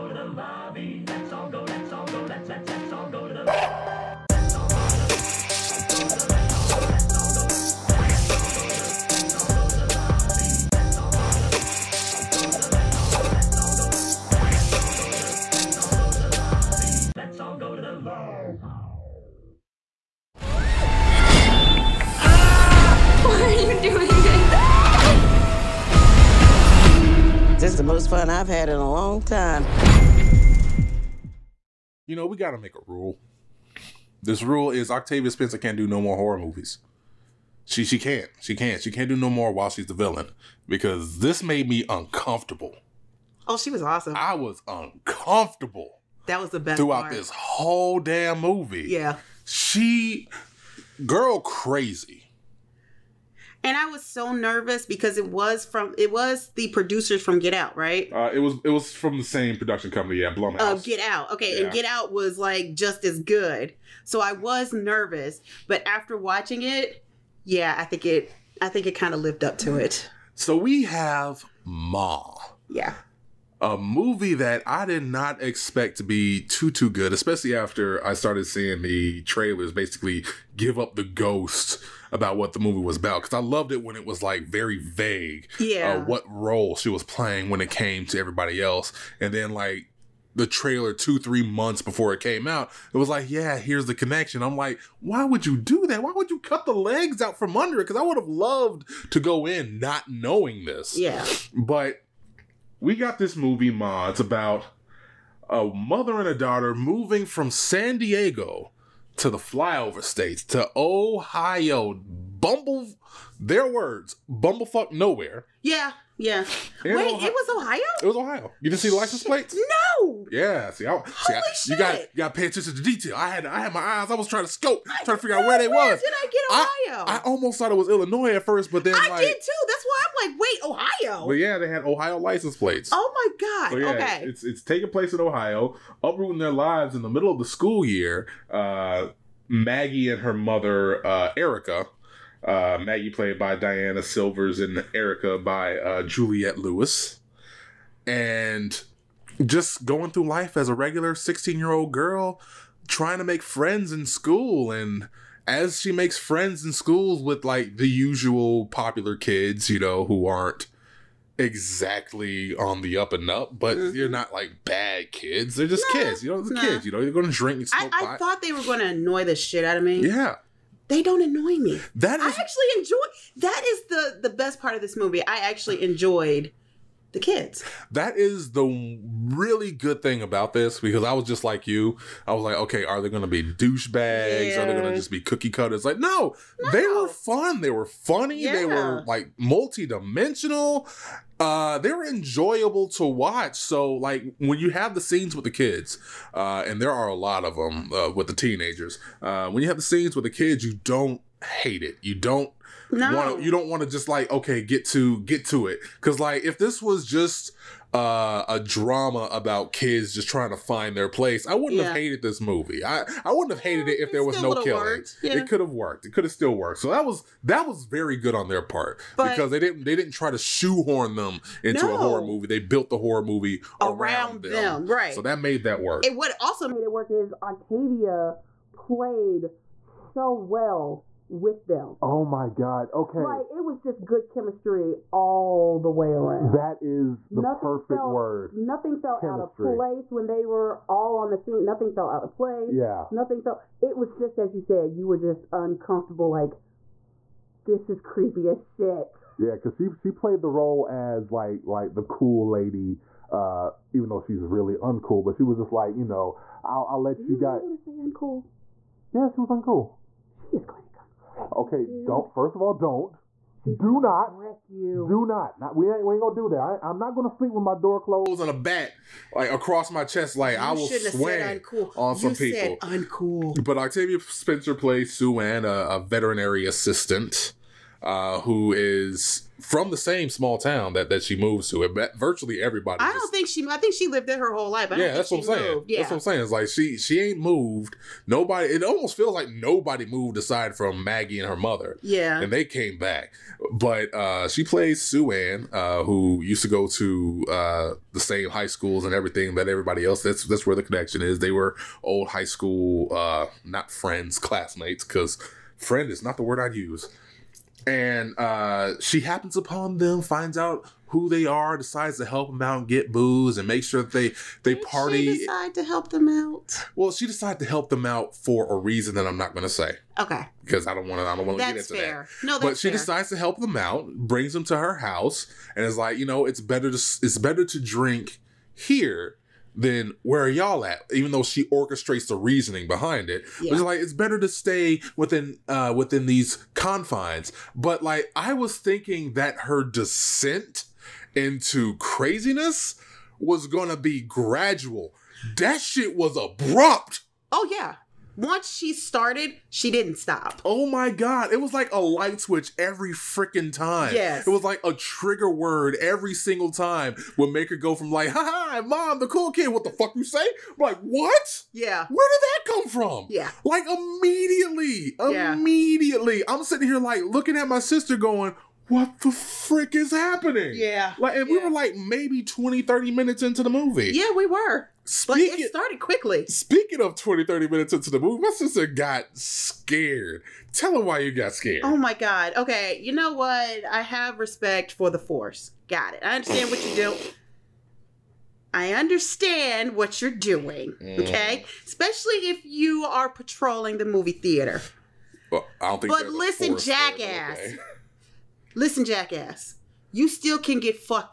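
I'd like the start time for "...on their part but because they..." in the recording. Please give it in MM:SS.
03:38.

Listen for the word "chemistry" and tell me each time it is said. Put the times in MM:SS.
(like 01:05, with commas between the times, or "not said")
03:54, 03:59.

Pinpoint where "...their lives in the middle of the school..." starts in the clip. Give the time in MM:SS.
02:16.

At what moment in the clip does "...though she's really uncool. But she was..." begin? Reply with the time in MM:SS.
04:14.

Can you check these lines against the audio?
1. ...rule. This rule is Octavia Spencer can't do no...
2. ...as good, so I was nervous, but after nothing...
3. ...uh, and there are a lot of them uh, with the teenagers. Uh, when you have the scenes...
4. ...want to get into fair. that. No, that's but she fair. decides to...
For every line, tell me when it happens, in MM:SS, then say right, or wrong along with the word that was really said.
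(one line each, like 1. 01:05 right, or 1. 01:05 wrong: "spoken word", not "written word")
1. 00:32 right
2. 01:03 wrong: "watching", not "nothing"
3. 03:16 right
4. 05:21 right.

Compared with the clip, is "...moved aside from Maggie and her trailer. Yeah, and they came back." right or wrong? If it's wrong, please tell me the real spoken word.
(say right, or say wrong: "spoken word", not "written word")
wrong: "mother", not "trailer".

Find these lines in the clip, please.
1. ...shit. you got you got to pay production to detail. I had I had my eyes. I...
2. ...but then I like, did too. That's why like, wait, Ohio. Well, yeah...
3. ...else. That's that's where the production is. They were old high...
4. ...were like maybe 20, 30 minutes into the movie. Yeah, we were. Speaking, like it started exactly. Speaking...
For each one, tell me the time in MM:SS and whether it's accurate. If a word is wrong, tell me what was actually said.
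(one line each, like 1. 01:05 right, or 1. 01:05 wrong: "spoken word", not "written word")
1. 02:01 wrong: "attention", not "production"
2. 02:08 right
3. 05:00 wrong: "connection", not "production"
4. 06:11 wrong: "quickly", not "exactly".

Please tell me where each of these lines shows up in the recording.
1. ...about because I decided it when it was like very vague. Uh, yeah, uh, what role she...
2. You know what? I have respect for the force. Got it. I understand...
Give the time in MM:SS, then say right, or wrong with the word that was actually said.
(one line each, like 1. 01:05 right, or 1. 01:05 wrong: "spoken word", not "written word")
1. 01:22 wrong: "loved", not "decided"
2. 06:23 right.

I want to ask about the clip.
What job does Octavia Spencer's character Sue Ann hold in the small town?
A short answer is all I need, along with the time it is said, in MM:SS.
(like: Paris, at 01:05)
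Veterinary assistant, at 04:36.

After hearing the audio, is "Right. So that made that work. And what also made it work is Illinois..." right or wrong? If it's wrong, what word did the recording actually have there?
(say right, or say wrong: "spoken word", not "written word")
wrong: "Octavia", not "Illinois".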